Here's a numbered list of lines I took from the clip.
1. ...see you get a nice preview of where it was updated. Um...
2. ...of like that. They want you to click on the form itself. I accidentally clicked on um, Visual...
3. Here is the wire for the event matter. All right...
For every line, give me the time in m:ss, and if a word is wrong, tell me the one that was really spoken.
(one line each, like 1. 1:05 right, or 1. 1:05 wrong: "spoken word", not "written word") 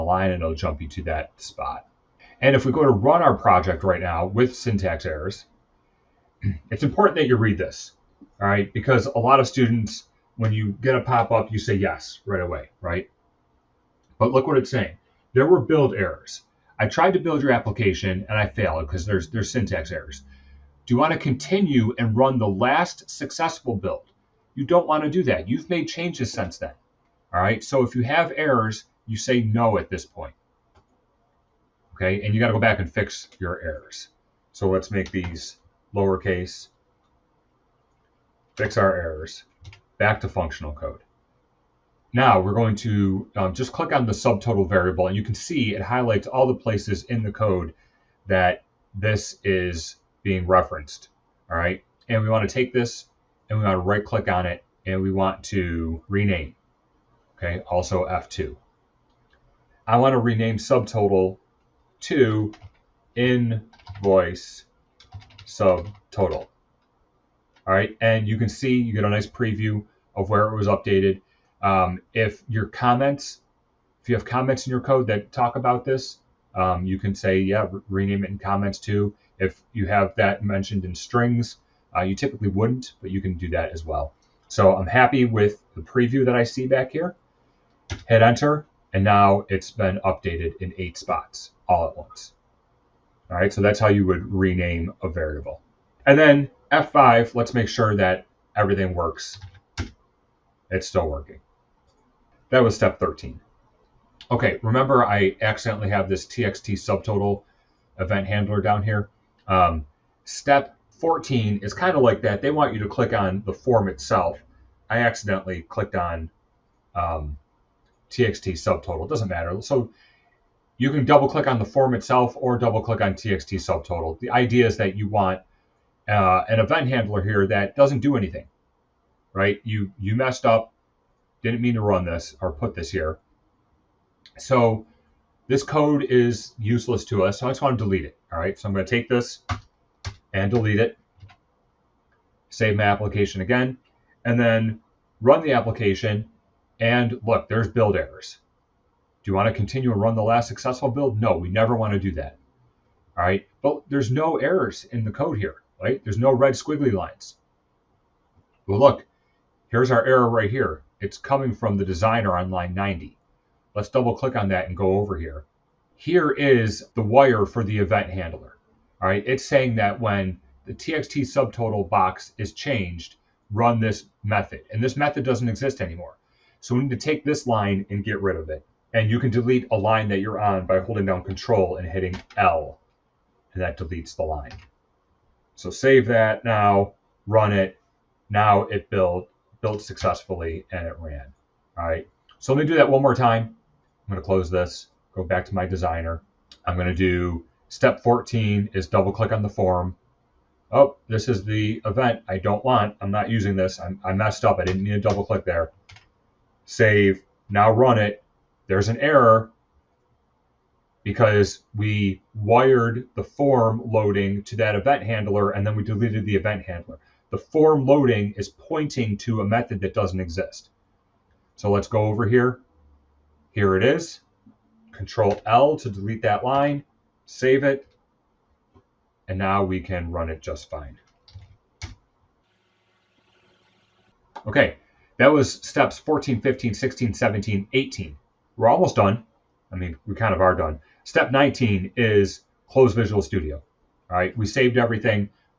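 1. 1:08 right
2. 1:51 wrong: "TXT", not "Visual"
3. 2:45 wrong: "handler", not "matter".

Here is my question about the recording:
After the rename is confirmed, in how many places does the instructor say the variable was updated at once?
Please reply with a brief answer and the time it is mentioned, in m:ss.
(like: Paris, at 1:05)
8, at 1:30.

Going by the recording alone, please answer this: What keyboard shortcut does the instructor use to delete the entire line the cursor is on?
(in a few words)
Control L.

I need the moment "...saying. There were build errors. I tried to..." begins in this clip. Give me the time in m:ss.
0:14.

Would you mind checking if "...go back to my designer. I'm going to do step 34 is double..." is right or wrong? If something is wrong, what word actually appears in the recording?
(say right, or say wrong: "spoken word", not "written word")
wrong: "14", not "34".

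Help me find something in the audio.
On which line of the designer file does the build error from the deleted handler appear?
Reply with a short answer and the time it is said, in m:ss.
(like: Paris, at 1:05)
90, at 2:42.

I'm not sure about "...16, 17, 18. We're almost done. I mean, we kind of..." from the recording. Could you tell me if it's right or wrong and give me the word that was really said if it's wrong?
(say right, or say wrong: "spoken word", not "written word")
right.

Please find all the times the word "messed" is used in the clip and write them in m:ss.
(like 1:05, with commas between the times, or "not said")
2:10, 3:24.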